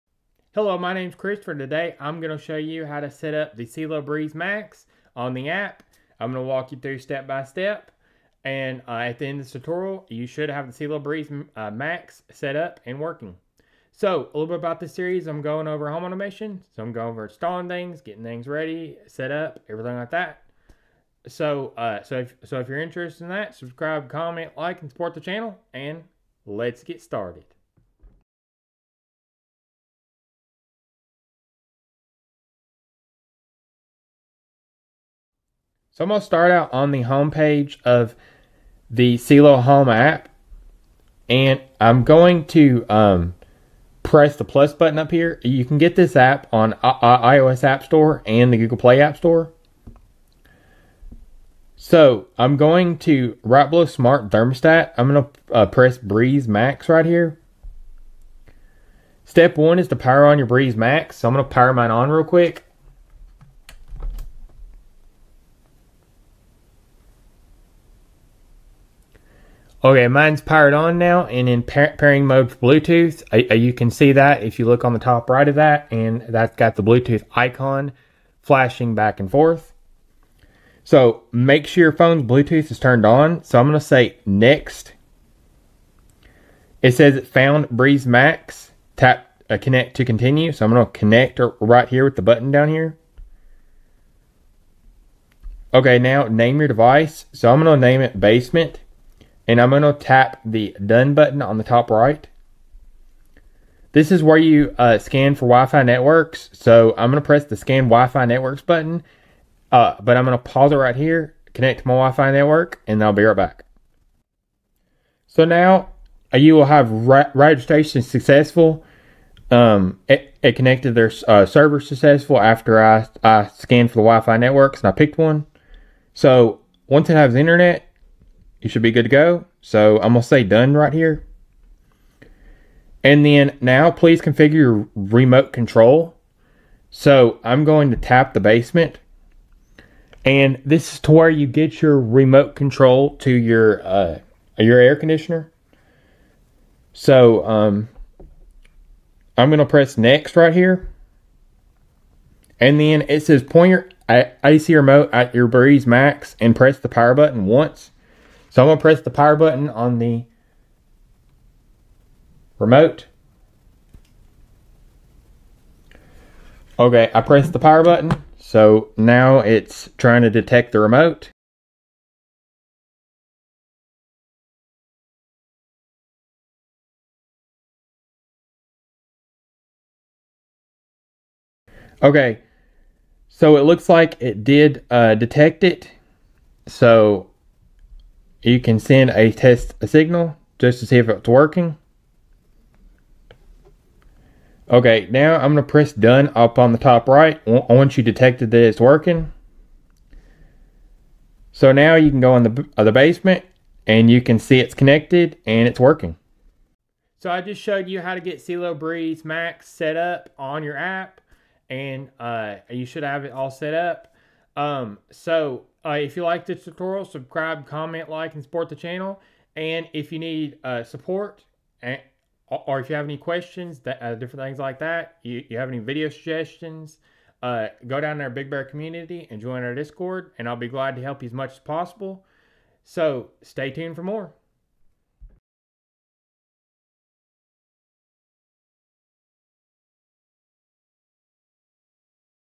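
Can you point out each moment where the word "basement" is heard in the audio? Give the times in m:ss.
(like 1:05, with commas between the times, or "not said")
1:38, 2:18, 3:22.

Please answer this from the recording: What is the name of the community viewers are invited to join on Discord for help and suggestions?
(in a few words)
Big Bear.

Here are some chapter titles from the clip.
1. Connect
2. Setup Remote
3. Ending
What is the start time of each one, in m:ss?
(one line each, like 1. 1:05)
1. 0:35
2. 1:54
3. 3:26.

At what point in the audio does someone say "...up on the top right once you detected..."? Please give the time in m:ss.
3:16.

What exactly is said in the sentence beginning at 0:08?
And uh, at the end of this tutorial, you should have the Cielo Breez uh, Max set up and working.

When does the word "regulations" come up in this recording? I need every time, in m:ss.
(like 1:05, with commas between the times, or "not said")
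not said.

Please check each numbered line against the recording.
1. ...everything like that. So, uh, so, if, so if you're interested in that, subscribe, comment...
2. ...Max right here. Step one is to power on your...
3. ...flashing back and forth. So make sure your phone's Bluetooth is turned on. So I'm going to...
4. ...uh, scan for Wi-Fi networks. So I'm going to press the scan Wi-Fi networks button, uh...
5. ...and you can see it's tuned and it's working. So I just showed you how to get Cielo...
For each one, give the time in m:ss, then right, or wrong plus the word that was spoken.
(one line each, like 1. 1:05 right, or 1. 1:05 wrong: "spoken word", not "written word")
1. 0:19 right
2. 0:56 right
3. 1:18 right
4. 1:44 right
5. 3:23 wrong: "connected", not "tuned".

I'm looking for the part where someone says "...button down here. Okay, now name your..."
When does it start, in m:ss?
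1:32.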